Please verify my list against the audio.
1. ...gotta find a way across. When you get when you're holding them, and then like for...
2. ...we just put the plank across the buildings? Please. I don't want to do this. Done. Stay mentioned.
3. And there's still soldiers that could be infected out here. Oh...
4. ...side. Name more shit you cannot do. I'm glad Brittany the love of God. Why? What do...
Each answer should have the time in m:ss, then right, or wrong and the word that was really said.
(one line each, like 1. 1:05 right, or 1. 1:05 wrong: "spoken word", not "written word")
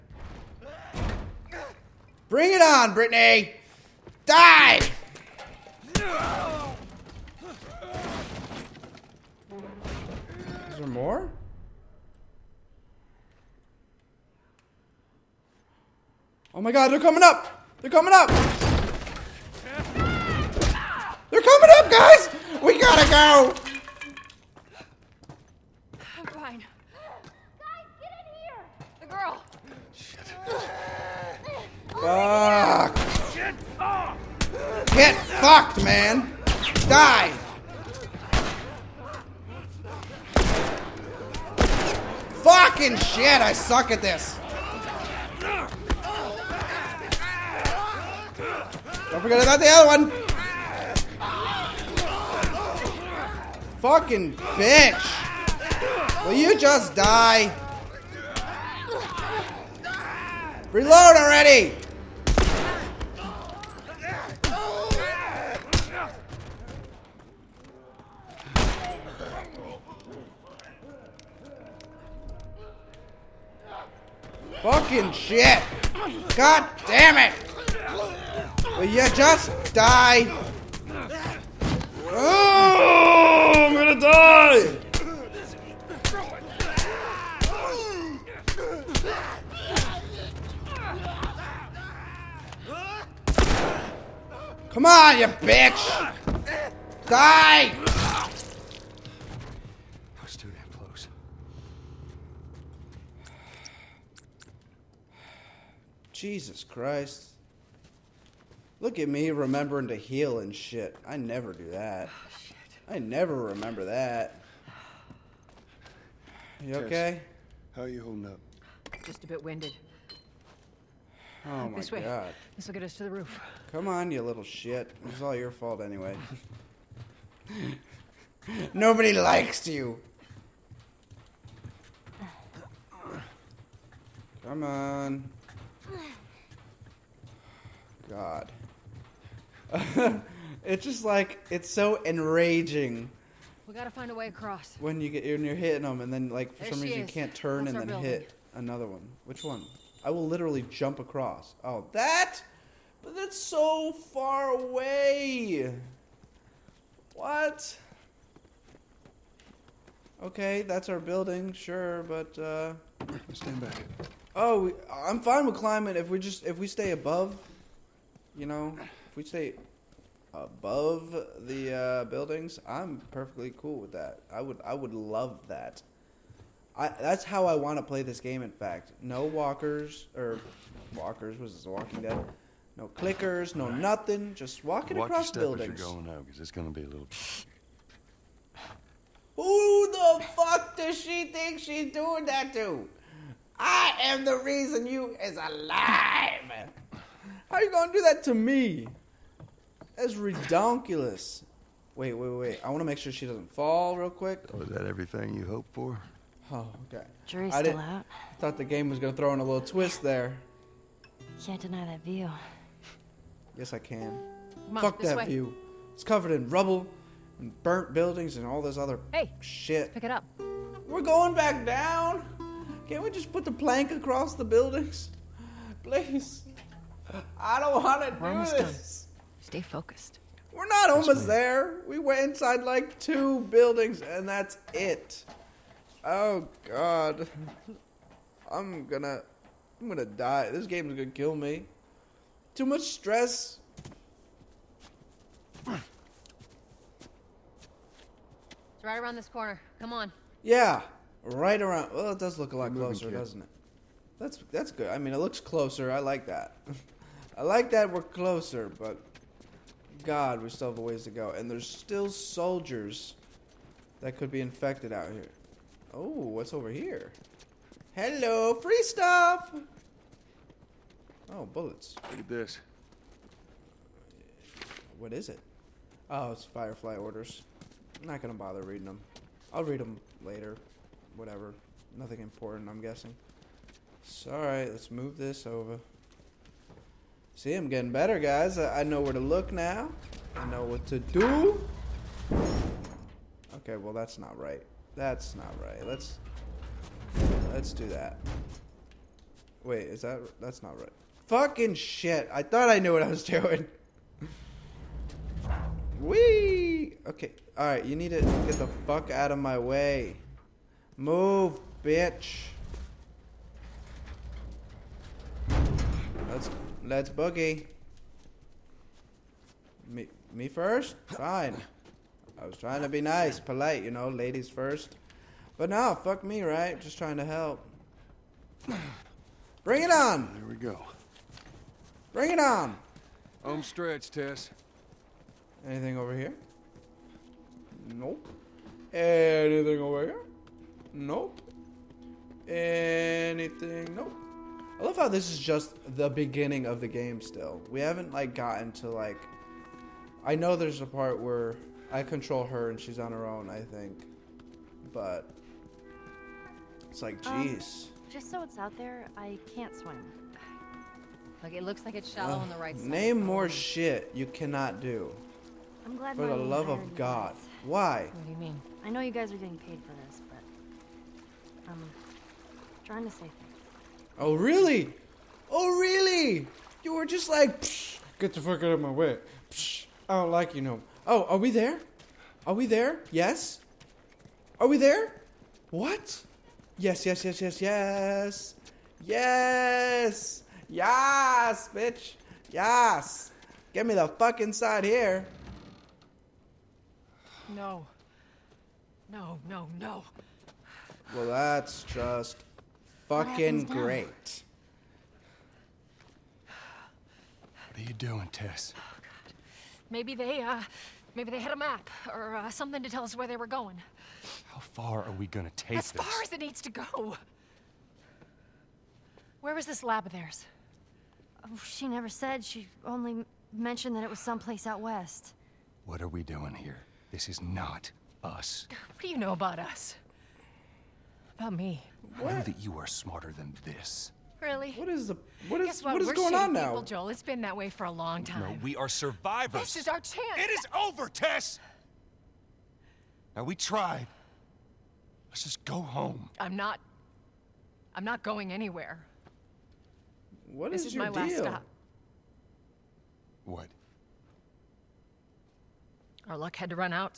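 1. 2:23 wrong: "hitting", not "holding"
2. 3:43 wrong: "focused", not "mentioned"
3. 4:21 right
4. 6:02 wrong: "For", not "Brittany".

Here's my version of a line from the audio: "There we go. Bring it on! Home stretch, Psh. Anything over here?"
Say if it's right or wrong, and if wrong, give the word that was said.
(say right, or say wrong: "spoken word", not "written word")
wrong: "Tess", not "Psh".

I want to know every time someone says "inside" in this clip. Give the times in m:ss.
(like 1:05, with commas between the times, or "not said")
3:52, 6:34.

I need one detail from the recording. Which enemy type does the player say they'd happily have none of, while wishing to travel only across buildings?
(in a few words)
Clickers.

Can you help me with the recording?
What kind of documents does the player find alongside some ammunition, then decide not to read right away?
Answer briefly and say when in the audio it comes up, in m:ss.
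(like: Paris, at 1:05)
Firefly orders, at 4:36.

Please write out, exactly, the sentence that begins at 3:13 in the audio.
I am the reason you is alive.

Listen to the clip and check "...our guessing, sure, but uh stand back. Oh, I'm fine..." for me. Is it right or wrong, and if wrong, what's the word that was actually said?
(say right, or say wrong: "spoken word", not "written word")
wrong: "building", not "guessing".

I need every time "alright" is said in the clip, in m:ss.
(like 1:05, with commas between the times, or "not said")
4:44.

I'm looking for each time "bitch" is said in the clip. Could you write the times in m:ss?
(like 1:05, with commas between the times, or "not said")
0:54, 1:35, 5:11, 6:31.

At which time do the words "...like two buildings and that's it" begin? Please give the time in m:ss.
3:52.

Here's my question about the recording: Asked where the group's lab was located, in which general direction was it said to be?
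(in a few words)
Out west.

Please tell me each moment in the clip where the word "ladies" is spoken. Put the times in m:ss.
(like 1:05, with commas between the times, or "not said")
5:24.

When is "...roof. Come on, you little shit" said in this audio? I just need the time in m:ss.
2:03.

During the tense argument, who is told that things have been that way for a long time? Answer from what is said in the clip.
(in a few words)
Joel.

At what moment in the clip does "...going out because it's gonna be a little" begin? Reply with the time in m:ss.
3:06.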